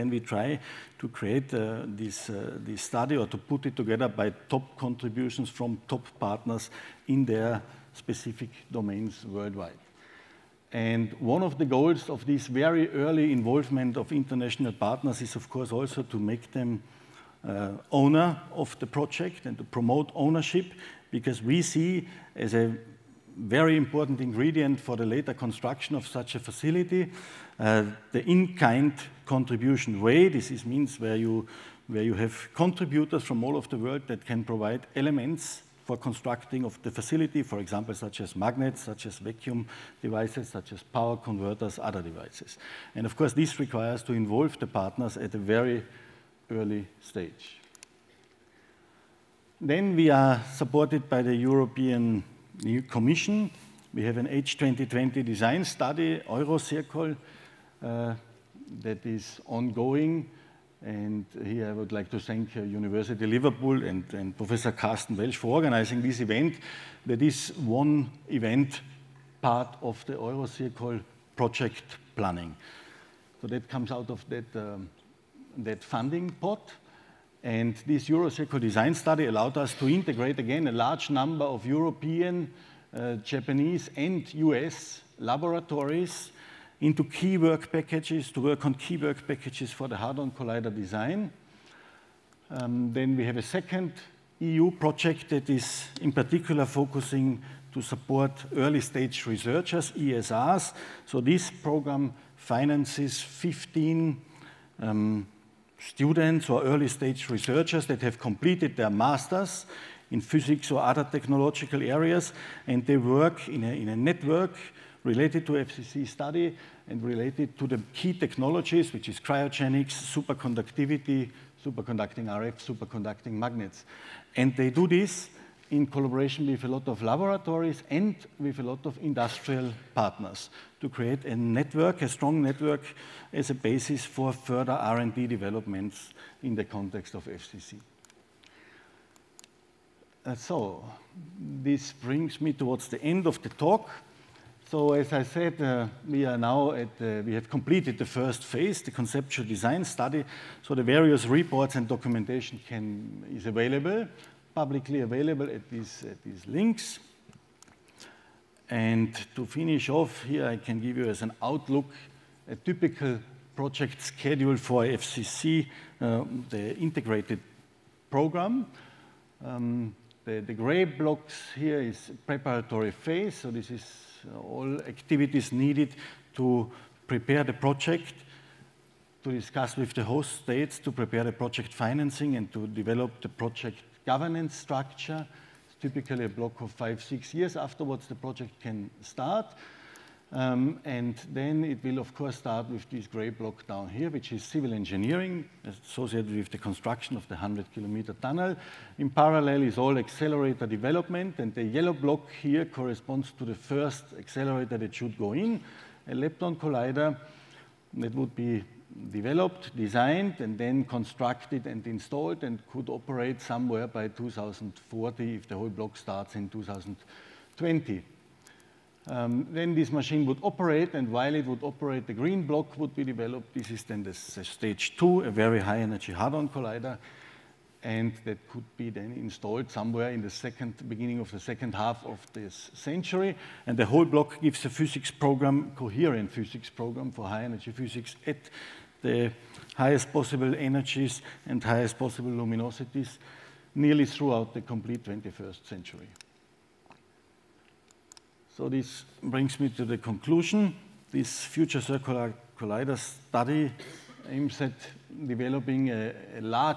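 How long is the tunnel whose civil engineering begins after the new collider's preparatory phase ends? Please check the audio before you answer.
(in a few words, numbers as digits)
100 kilometers.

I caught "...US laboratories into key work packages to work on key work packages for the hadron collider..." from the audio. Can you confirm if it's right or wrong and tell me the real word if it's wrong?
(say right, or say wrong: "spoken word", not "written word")
right.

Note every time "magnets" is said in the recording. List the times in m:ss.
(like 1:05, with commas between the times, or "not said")
0:38, 2:03.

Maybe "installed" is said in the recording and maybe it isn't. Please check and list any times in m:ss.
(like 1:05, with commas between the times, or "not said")
3:31, 3:49.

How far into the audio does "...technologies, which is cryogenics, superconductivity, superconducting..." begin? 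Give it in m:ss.
1:58.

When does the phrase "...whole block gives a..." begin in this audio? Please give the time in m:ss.
3:53.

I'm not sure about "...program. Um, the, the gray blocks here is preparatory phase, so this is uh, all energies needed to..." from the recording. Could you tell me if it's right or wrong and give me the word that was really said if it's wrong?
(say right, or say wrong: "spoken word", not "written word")
wrong: "activities", not "energies".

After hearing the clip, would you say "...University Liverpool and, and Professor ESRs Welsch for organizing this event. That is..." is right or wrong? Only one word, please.
wrong.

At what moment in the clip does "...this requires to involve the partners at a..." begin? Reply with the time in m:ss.
0:43.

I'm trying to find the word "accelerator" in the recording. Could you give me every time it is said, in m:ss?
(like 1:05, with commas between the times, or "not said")
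3:19, 3:24.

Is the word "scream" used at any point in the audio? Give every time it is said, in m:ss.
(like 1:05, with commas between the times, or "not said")
not said.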